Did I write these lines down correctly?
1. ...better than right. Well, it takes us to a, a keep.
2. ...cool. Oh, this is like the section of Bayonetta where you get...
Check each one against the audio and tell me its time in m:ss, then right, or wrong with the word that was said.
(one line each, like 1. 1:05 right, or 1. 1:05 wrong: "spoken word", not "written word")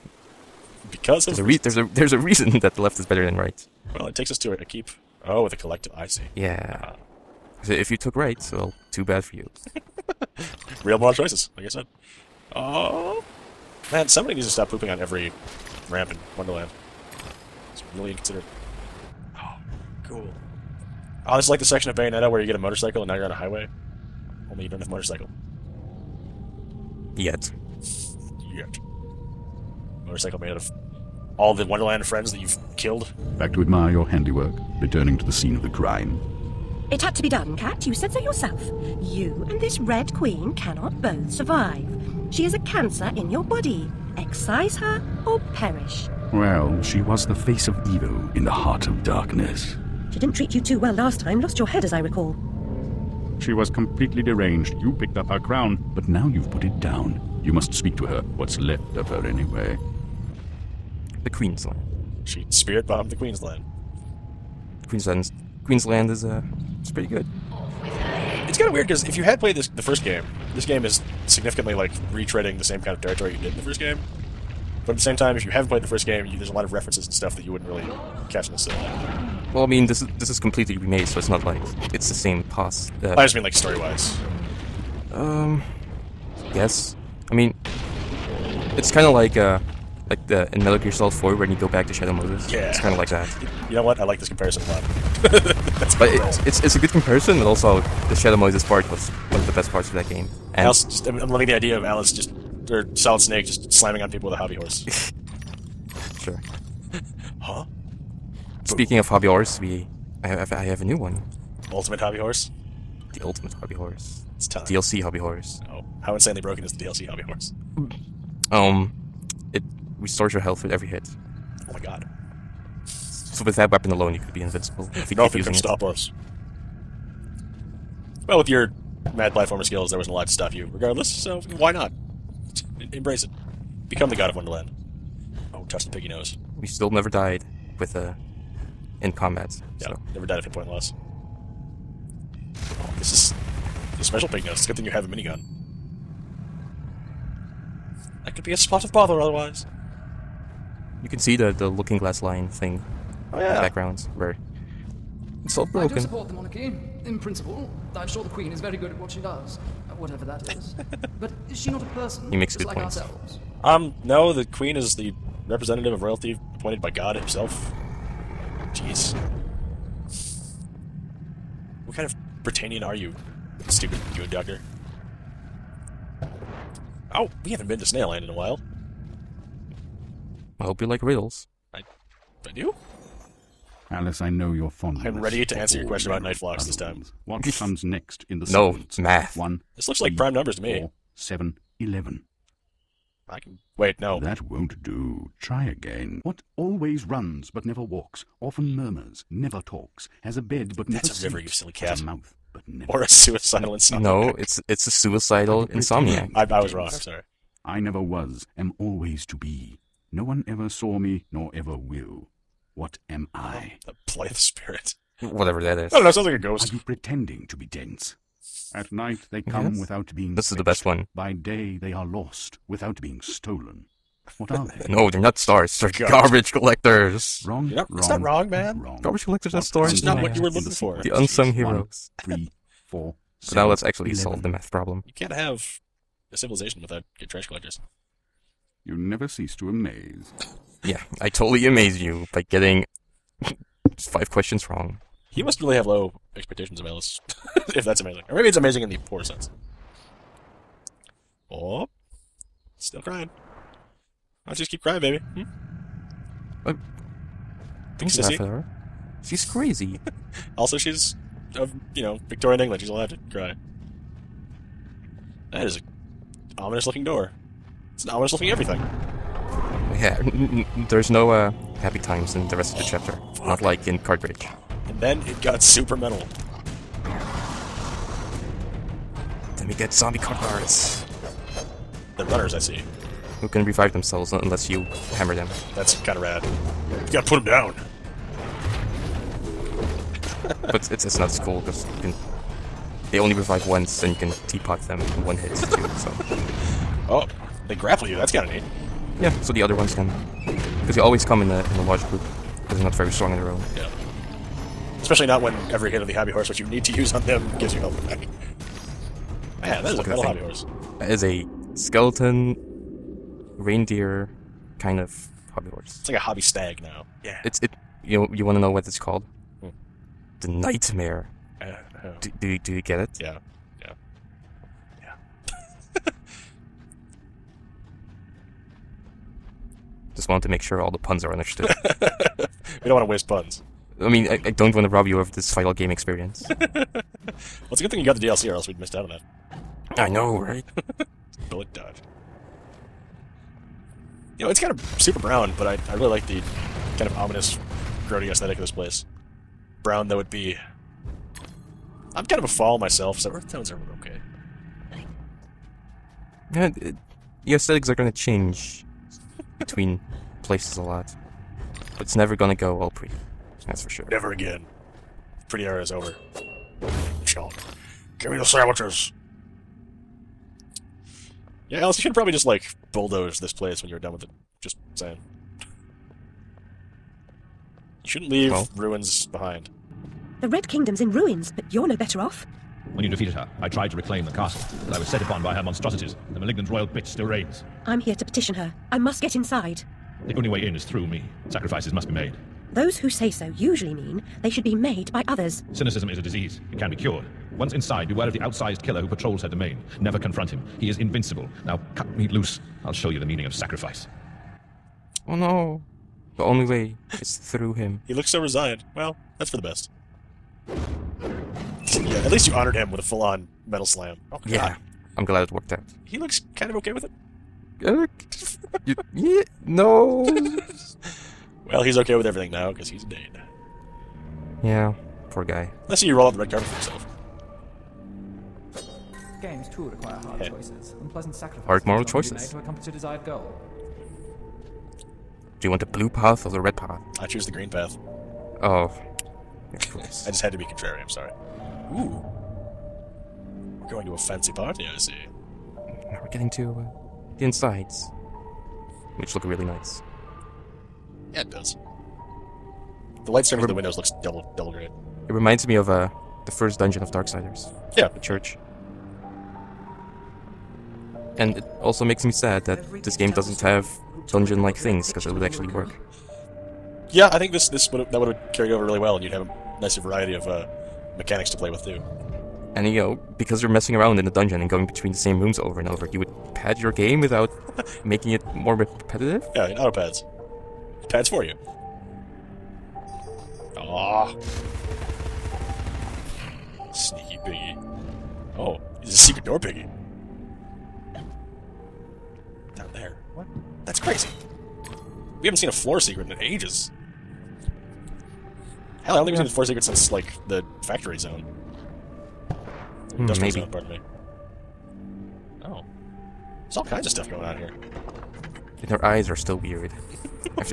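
1. 0:03 right
2. 0:20 right.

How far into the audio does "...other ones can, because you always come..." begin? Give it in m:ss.
4:59.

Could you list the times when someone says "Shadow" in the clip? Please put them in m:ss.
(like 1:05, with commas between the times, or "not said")
1:31, 1:38.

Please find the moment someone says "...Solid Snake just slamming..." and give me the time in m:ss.
1:42.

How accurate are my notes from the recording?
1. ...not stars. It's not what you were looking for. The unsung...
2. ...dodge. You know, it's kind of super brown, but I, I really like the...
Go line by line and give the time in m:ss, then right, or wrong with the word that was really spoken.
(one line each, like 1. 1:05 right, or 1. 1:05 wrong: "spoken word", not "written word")
1. 3:49 right
2. 5:41 right.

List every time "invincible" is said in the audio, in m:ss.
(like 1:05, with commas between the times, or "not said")
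2:04, 6:40.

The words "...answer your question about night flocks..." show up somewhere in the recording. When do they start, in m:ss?
3:05.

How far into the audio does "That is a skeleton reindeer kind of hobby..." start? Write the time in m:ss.
5:10.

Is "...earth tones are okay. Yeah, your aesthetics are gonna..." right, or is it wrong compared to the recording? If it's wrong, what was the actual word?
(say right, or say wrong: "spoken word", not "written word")
right.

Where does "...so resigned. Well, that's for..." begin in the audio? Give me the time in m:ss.
6:48.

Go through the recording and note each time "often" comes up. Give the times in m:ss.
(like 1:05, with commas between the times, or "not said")
3:18.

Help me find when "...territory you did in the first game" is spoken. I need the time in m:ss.
1:13.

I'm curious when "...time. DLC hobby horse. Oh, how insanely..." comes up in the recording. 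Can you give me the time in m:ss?
1:54.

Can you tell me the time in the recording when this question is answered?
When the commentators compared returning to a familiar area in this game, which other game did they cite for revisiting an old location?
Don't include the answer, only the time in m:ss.
1:30.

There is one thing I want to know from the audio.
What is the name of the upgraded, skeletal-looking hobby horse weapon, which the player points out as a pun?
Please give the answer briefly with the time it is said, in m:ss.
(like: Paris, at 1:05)
The Nightmare, at 5:20.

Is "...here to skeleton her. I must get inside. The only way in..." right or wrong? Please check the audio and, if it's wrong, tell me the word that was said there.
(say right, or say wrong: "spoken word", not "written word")
wrong: "petition", not "skeleton".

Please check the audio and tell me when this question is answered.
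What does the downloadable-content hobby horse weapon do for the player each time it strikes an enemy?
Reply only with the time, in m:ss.
1:59.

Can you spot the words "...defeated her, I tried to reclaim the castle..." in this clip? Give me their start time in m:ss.
6:23.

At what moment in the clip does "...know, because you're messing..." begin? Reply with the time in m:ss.
7:52.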